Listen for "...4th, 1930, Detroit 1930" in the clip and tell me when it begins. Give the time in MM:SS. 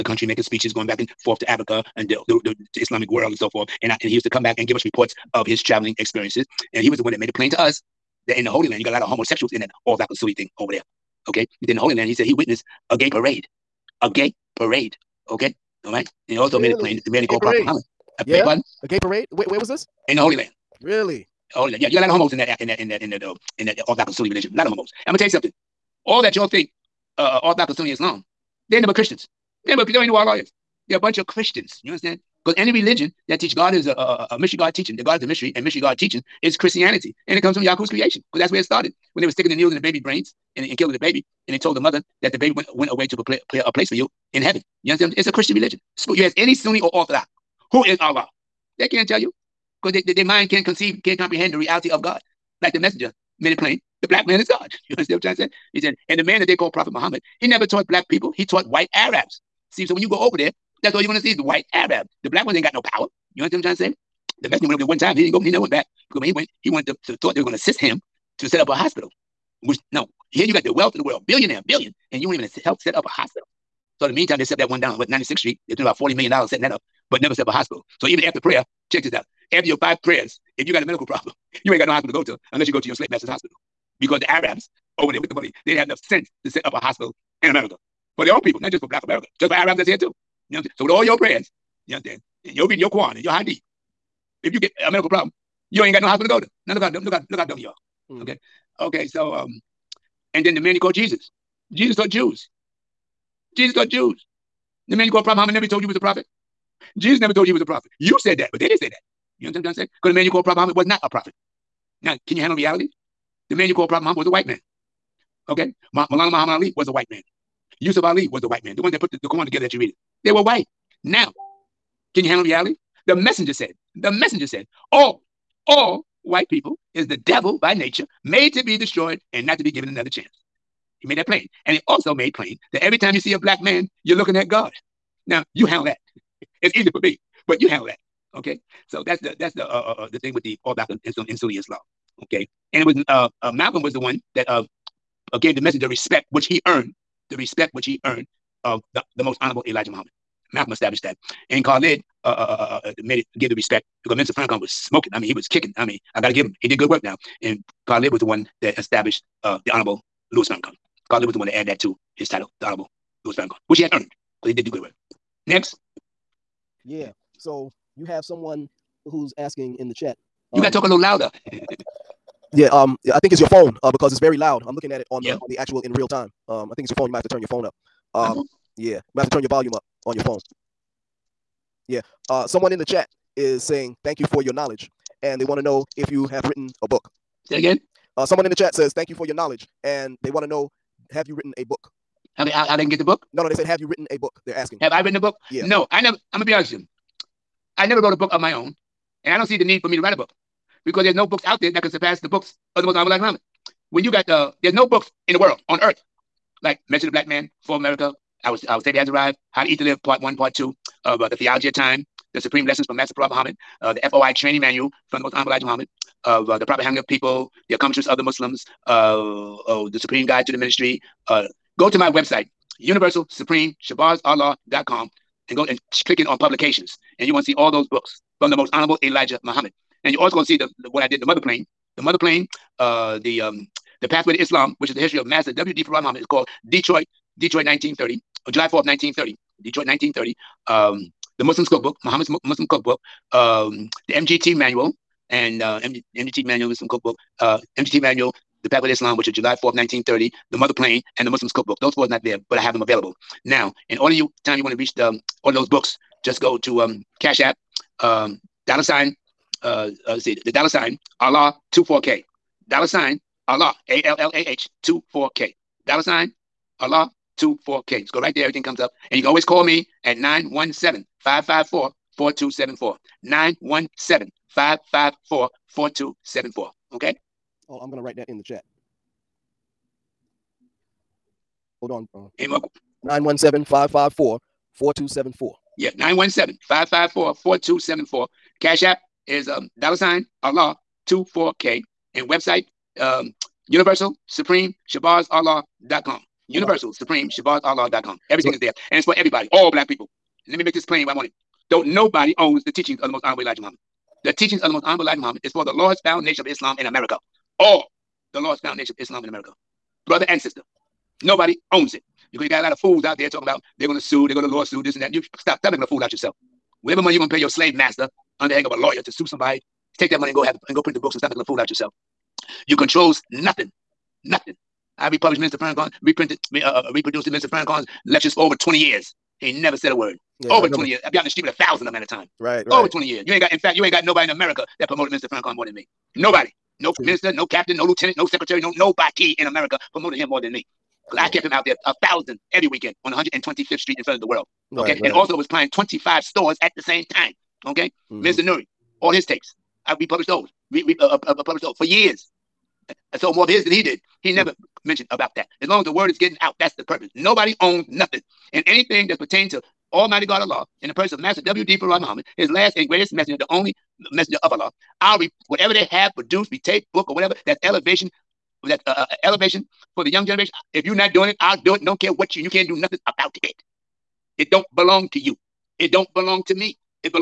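03:58.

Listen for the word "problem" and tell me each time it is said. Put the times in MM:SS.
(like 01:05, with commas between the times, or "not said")
01:21, 01:35.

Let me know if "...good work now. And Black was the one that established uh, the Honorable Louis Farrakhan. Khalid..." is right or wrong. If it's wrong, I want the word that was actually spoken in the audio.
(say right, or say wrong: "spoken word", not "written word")
wrong: "Khalid", not "Black".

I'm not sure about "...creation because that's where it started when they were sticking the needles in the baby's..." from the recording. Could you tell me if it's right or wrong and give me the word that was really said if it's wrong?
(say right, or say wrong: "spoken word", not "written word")
right.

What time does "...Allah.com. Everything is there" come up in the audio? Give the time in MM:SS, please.
04:57.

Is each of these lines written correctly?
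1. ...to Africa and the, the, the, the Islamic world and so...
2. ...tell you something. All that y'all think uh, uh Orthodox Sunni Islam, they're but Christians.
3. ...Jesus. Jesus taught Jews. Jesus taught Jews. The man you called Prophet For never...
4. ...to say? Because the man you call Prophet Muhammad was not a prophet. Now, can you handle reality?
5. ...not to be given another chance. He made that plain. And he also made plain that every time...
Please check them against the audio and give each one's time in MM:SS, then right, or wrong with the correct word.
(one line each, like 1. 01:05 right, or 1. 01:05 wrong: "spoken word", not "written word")
1. 00:01 right
2. 00:25 right
3. 01:40 wrong: "Muhammad", not "For"
4. 01:49 right
5. 02:09 right.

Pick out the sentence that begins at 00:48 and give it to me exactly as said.
They can't tell you because they, they, their mind can't conceive, can't comprehend the reality of God.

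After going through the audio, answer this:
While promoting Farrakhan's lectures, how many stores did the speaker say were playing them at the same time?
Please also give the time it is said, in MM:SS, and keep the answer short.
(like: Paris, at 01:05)
25, at 05:45.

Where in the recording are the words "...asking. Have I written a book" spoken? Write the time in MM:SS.
03:14.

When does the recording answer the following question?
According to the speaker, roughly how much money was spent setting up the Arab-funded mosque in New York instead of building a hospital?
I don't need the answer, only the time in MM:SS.
01:15.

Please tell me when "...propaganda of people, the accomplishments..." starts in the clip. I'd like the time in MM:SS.
03:36.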